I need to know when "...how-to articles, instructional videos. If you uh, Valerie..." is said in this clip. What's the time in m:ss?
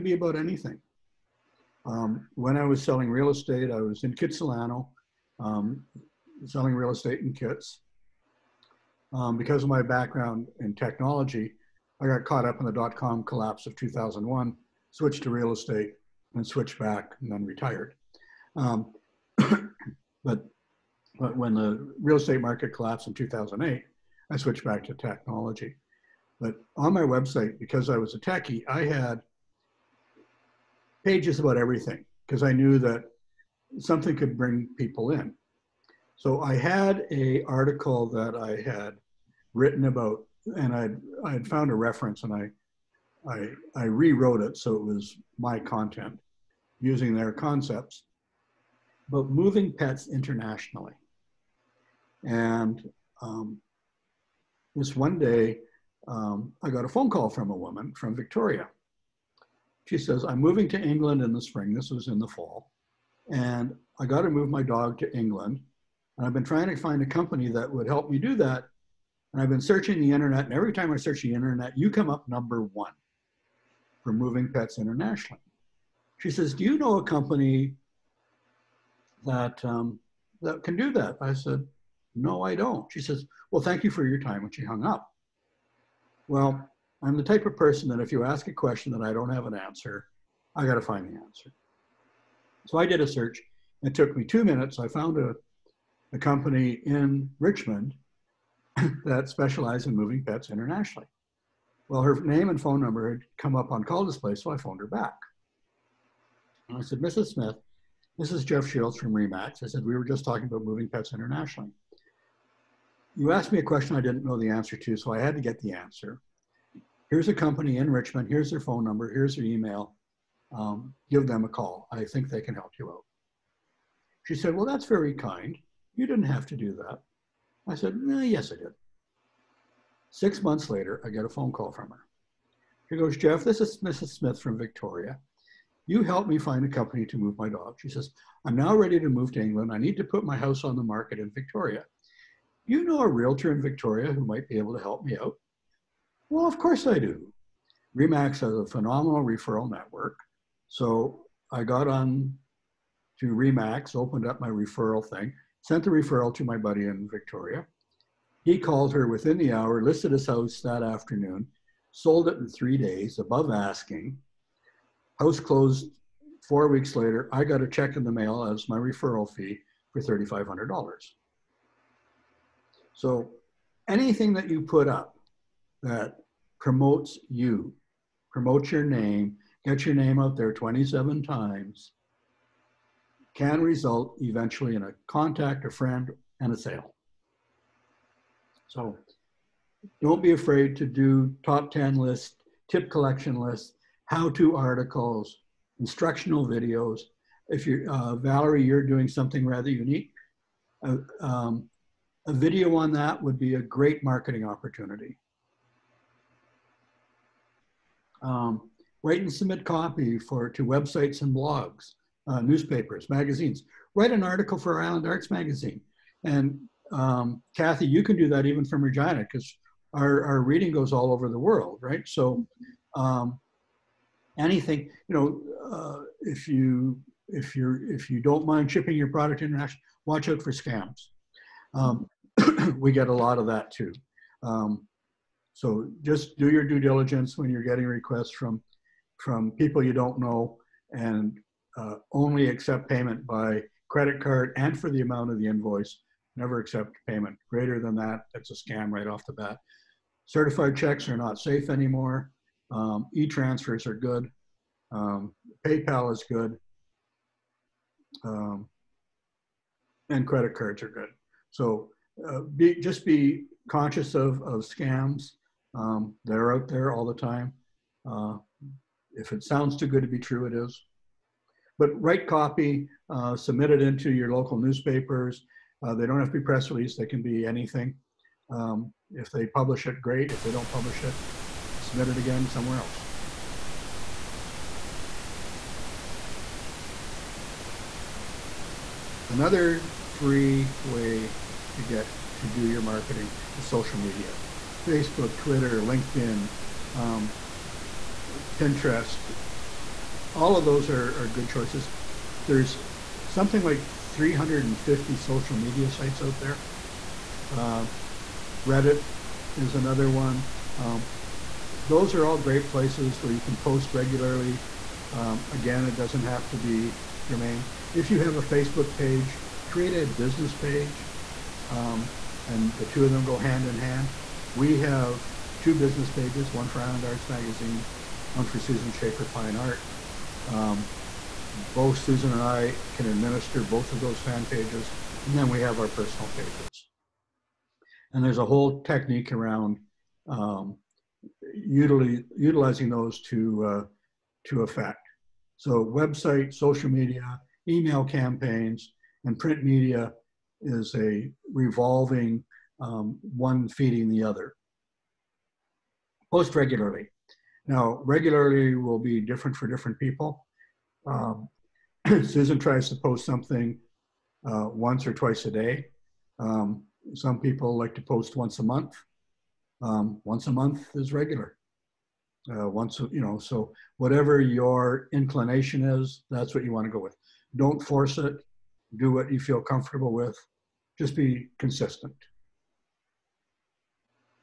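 3:14.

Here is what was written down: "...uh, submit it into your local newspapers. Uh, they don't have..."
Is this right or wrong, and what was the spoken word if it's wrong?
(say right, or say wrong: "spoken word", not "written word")
right.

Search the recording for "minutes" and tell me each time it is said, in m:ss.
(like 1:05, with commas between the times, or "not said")
1:34.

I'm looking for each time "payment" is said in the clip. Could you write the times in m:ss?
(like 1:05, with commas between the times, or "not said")
4:02, 4:07.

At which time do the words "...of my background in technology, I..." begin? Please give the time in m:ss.
0:09.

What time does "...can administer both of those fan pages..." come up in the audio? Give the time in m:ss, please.
5:32.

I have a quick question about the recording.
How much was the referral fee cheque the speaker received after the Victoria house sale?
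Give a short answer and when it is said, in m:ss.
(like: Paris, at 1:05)
$3,500, at 2:50.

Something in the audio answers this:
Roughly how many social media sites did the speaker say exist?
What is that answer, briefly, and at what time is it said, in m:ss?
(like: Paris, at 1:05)
350, at 5:04.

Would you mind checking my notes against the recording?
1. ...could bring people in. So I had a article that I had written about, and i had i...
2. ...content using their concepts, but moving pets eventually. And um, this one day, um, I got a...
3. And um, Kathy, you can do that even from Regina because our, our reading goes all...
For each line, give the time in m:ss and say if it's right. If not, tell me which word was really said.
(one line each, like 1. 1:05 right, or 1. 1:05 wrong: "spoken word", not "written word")
1. 0:34 right
2. 0:45 wrong: "internationally", not "eventually"
3. 3:36 right.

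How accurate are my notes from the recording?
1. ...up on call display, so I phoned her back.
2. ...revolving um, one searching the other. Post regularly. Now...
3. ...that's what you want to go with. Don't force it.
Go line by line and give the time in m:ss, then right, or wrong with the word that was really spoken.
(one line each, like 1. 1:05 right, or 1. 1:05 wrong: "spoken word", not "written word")
1. 1:43 right
2. 5:51 wrong: "feeding", not "searching"
3. 6:16 right.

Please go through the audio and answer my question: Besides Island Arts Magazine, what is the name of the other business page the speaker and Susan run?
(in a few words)
Susan Schaefer Fine Art.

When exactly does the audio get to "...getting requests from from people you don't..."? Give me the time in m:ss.
3:57.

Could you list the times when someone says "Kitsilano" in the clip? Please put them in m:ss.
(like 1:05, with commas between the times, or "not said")
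0:04.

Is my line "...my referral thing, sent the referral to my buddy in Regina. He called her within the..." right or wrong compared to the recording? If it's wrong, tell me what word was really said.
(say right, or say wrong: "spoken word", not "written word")
wrong: "Victoria", not "Regina".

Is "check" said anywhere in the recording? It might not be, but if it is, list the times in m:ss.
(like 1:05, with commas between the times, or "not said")
2:47, 4:10.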